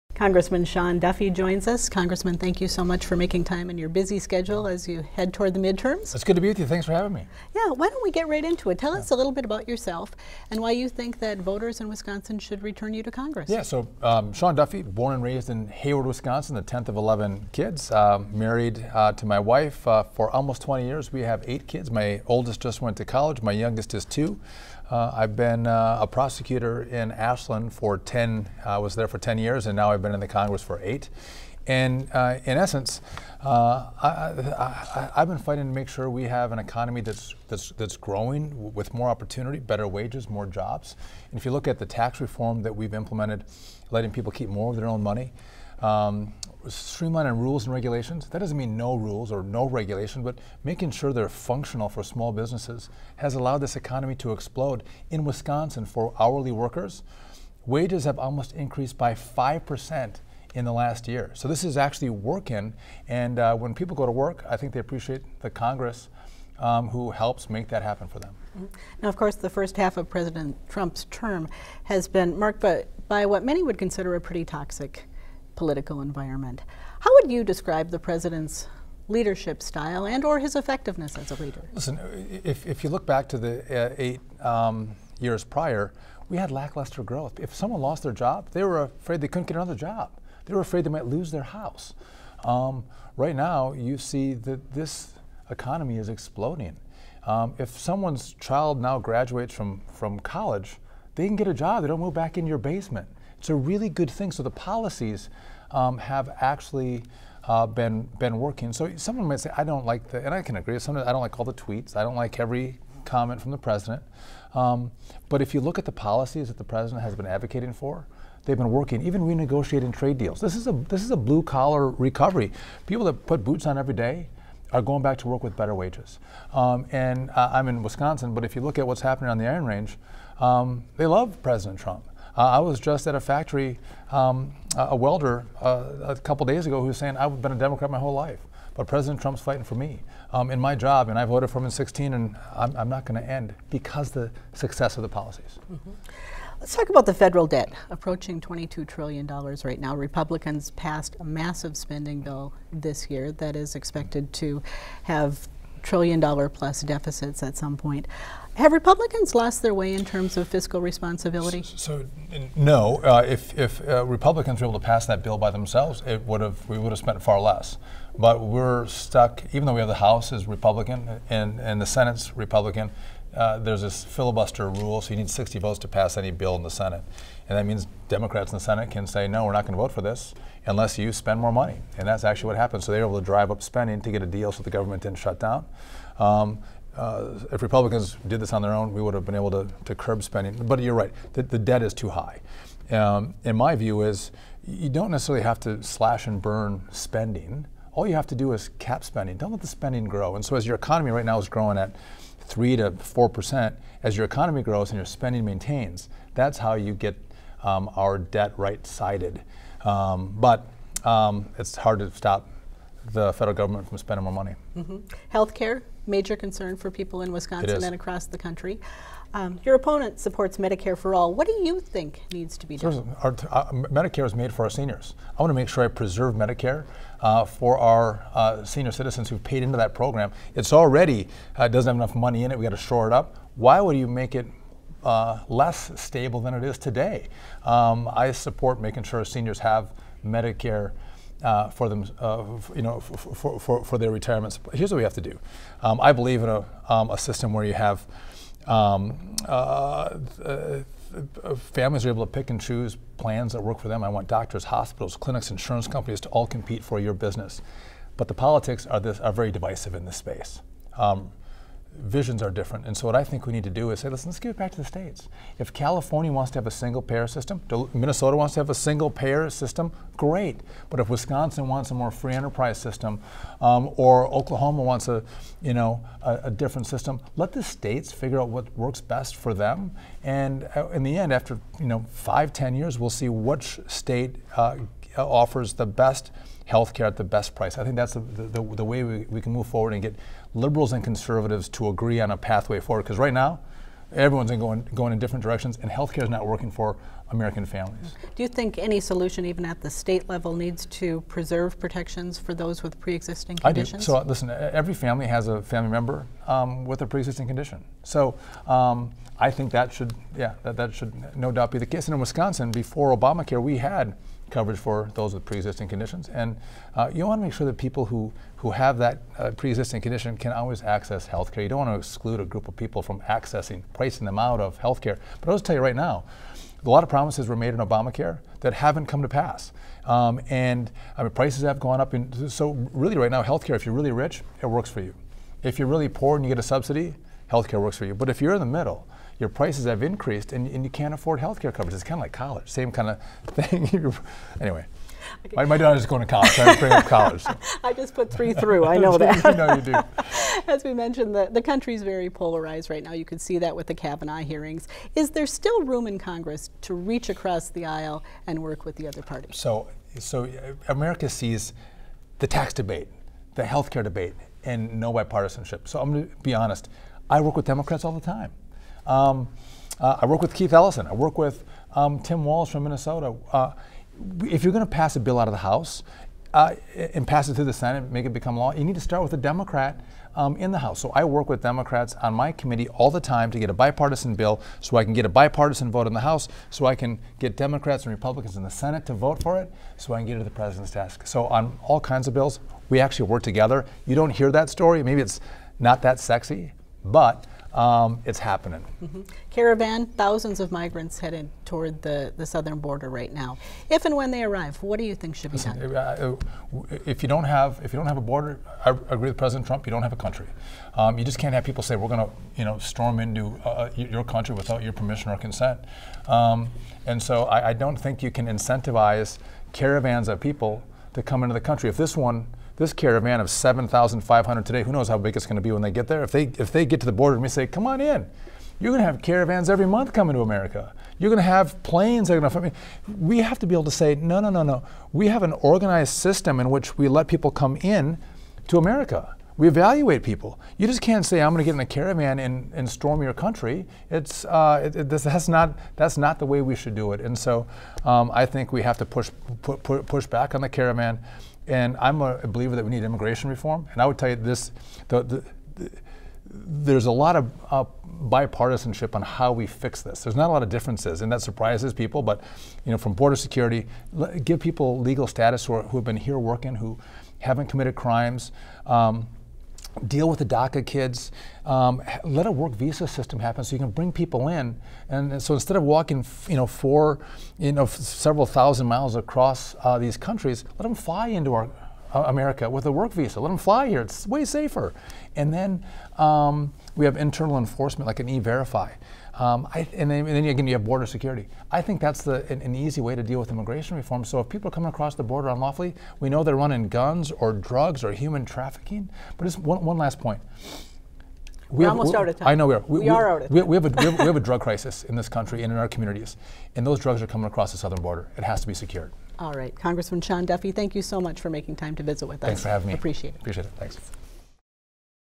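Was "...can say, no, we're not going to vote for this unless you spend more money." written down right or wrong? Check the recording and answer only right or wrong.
right.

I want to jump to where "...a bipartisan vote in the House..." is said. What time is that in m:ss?
6:25.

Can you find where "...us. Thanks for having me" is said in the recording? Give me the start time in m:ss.
8:32.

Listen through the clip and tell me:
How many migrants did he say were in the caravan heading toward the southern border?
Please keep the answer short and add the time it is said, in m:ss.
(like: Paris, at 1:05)
7,500, at 7:03.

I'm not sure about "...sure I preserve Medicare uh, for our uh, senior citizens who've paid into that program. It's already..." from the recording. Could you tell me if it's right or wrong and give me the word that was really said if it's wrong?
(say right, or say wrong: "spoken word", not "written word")
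right.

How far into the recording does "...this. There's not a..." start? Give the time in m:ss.
7:40.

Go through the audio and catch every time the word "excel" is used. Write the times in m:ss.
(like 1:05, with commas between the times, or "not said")
not said.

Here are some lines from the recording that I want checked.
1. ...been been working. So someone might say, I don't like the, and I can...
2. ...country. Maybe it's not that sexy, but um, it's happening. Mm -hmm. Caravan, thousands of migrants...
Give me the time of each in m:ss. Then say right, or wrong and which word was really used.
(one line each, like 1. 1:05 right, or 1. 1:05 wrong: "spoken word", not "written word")
1. 1:47 right
2. 6:34 wrong: "story", not "country".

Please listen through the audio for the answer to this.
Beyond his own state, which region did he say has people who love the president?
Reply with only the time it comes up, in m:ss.
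2:09.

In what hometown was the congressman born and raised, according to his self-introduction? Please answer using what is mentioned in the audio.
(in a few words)
Hayward, Wisconsin.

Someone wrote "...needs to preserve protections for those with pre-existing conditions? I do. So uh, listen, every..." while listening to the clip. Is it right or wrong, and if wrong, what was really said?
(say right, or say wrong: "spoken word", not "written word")
right.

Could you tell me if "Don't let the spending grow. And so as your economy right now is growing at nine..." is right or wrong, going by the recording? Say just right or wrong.
wrong.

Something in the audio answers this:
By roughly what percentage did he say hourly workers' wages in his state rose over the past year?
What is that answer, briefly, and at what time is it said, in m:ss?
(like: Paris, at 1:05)
5%, at 0:59.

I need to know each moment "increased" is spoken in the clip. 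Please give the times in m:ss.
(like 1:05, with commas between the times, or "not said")
0:58, 5:40.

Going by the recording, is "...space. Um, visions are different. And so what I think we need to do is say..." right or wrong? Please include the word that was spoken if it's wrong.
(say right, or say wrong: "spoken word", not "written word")
right.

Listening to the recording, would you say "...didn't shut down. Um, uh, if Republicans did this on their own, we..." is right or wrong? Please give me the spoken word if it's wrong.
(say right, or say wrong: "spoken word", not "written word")
right.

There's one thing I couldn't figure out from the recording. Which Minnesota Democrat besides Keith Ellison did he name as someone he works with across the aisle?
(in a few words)
Tim Walz.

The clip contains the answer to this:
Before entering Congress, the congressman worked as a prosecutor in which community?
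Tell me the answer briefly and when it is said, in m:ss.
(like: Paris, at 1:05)
Ashland, at 0:27.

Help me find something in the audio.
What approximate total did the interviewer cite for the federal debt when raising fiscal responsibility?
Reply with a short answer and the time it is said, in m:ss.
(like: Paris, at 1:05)
$22 trillion, at 2:28.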